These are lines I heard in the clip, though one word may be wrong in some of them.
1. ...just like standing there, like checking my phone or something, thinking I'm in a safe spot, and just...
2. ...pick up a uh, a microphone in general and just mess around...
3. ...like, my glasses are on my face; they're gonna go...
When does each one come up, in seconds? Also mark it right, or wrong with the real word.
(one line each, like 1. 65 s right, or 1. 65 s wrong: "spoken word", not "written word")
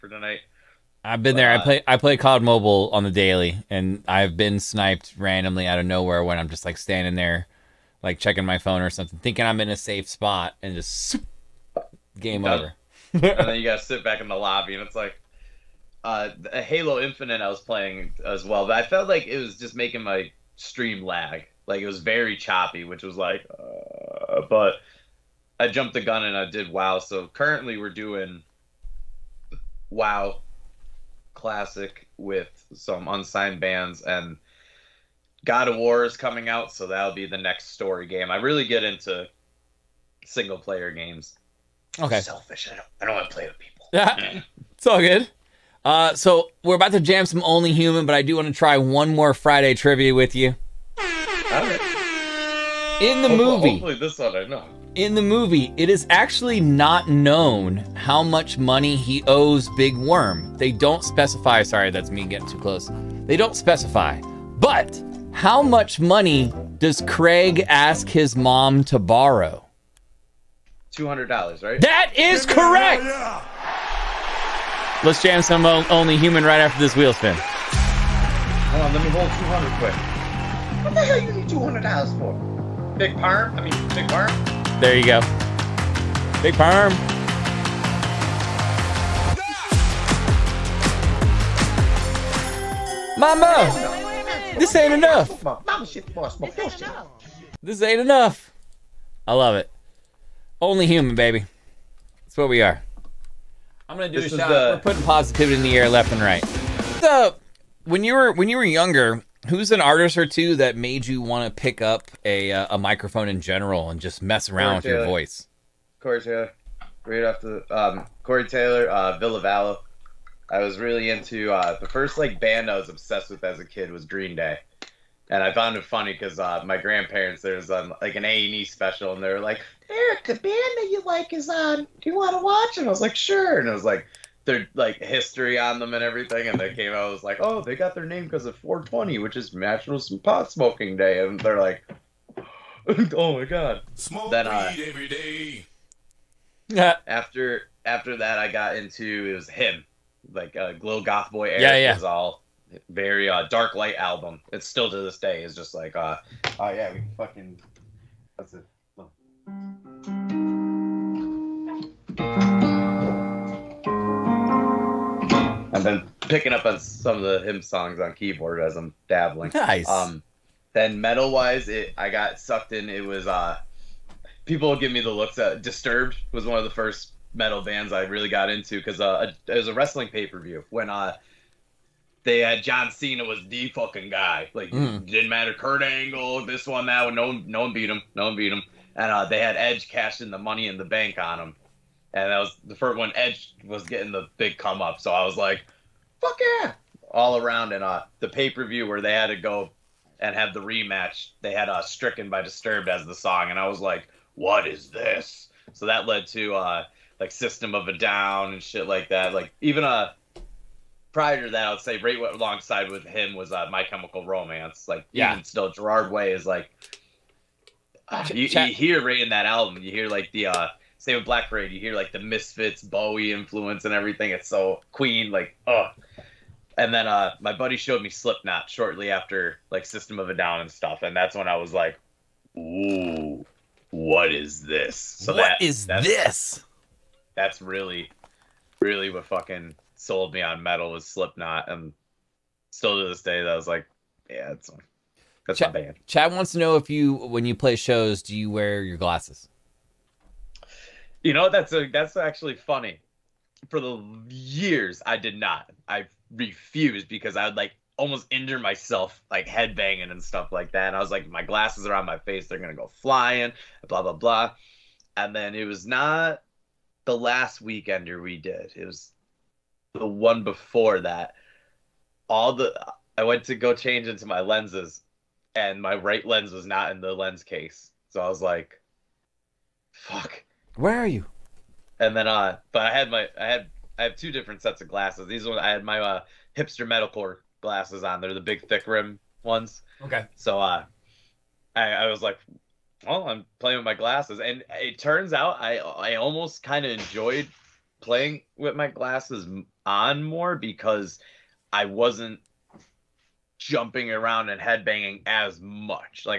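1. 6 s right
2. 111 s right
3. 261 s right.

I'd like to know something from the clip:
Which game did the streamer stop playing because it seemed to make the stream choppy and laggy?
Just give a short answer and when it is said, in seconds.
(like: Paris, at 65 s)
Halo Infinite, at 16 s.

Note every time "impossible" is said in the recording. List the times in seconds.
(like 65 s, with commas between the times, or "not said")
not said.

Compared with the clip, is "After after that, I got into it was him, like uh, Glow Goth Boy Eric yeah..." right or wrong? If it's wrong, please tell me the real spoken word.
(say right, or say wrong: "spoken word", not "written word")
right.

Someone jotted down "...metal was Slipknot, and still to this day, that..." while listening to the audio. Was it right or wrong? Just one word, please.
right.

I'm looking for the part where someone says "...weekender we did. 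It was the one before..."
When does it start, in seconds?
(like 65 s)
267 s.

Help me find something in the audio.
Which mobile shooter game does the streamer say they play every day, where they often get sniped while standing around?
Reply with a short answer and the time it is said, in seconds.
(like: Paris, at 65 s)
COD Mobile, at 2 s.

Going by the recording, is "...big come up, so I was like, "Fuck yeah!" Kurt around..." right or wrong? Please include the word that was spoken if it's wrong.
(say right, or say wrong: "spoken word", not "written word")
wrong: "All", not "Kurt".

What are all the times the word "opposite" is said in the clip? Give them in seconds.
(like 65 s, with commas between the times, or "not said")
not said.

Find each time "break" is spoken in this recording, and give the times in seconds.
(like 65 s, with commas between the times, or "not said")
not said.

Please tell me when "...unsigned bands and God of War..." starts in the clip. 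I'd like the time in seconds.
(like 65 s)
33 s.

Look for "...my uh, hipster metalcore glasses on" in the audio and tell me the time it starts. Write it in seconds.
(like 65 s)
285 s.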